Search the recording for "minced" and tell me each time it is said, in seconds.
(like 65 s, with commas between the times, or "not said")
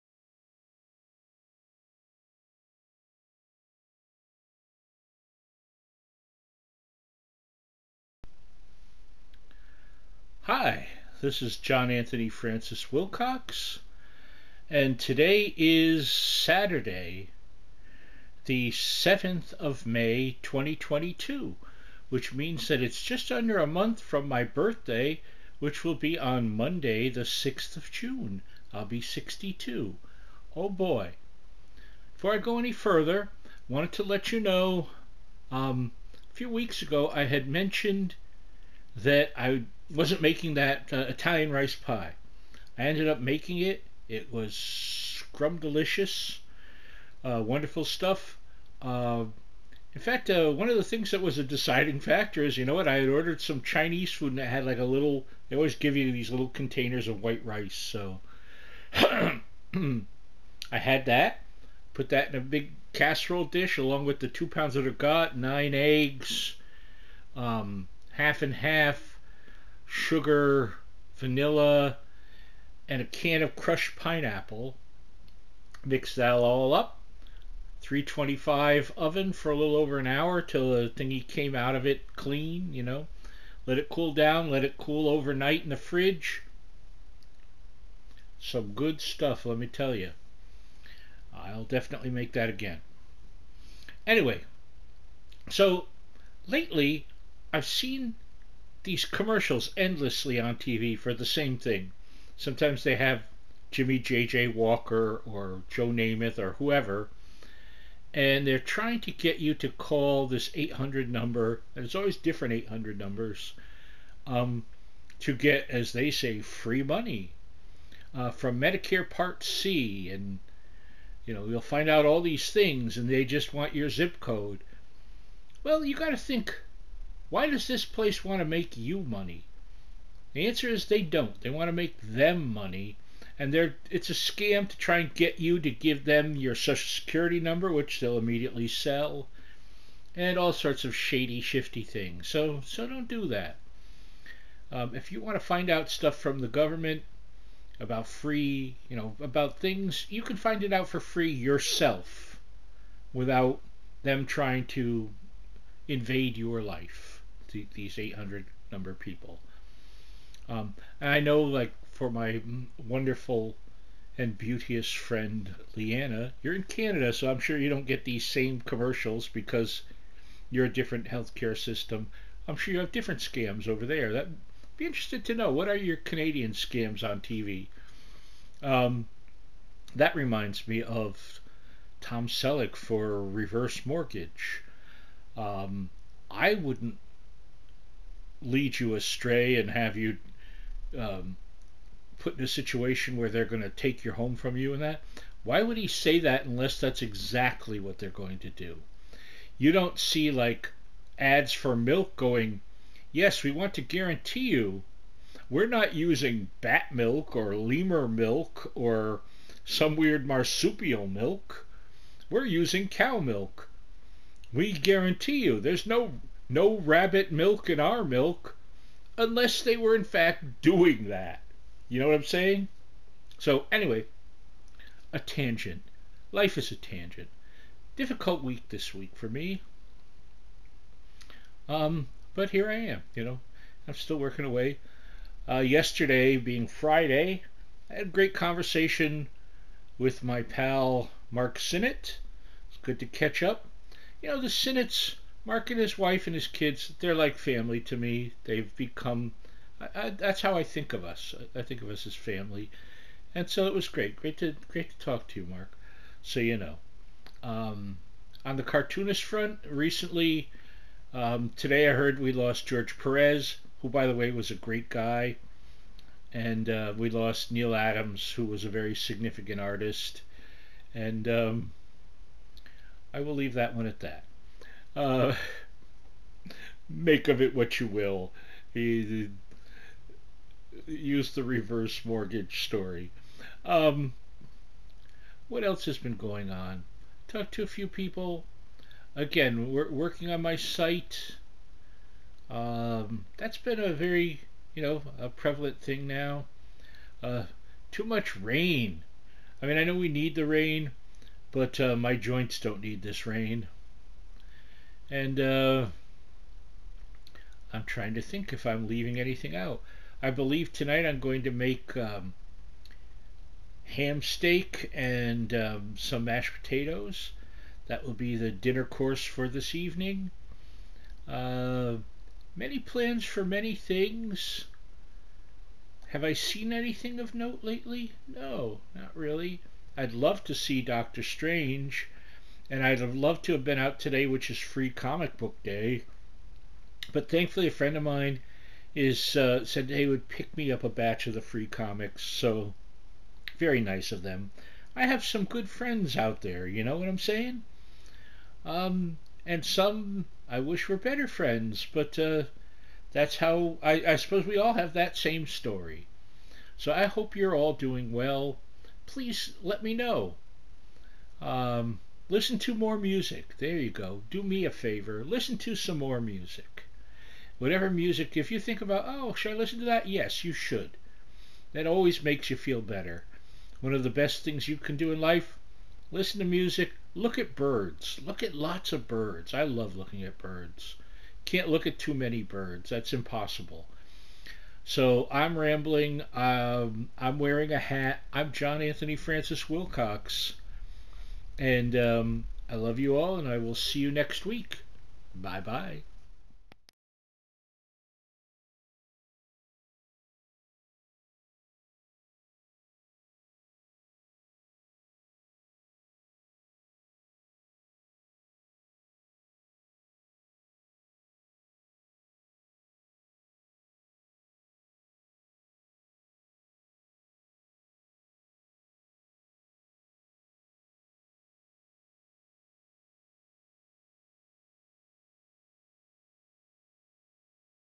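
not said.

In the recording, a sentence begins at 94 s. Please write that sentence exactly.
Anyway, so lately I've seen these commercials endlessly on TV for the same thing.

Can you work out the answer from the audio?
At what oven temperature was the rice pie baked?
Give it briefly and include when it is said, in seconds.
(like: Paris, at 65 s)
325, at 77 s.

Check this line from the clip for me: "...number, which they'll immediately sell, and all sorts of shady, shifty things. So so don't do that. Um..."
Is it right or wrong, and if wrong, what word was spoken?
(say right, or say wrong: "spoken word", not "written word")
right.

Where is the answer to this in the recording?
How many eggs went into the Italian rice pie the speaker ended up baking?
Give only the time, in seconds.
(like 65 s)
65 s.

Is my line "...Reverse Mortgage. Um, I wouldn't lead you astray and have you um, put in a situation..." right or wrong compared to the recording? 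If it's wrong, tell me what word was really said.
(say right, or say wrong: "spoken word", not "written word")
right.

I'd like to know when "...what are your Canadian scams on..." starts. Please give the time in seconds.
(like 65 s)
175 s.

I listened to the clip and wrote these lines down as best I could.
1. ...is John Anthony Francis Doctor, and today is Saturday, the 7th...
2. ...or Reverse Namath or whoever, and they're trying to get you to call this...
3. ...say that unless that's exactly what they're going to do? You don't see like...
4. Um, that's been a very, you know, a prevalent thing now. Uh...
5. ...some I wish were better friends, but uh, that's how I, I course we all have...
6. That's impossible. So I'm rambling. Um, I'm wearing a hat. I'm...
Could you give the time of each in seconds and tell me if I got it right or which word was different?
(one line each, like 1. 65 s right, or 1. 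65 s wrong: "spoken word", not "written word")
1. 11 s wrong: "Wilcox", not "Doctor"
2. 105 s wrong: "Joe", not "Reverse"
3. 195 s right
4. 292 s right
5. 349 s wrong: "suppose", not "course"
6. 382 s right.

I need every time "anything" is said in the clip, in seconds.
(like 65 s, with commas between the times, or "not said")
309 s, 326 s.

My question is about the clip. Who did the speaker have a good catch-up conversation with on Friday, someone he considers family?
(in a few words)
Mark Sinnott.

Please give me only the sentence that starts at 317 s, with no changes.
That will be the dinner course for this evening.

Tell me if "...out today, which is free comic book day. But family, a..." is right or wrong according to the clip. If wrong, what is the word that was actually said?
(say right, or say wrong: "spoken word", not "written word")
wrong: "thankfully", not "family".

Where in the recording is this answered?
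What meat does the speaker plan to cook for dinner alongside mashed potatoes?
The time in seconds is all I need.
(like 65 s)
313 s.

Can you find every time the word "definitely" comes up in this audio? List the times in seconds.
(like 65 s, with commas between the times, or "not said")
91 s.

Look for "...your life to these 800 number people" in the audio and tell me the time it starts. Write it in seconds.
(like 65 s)
156 s.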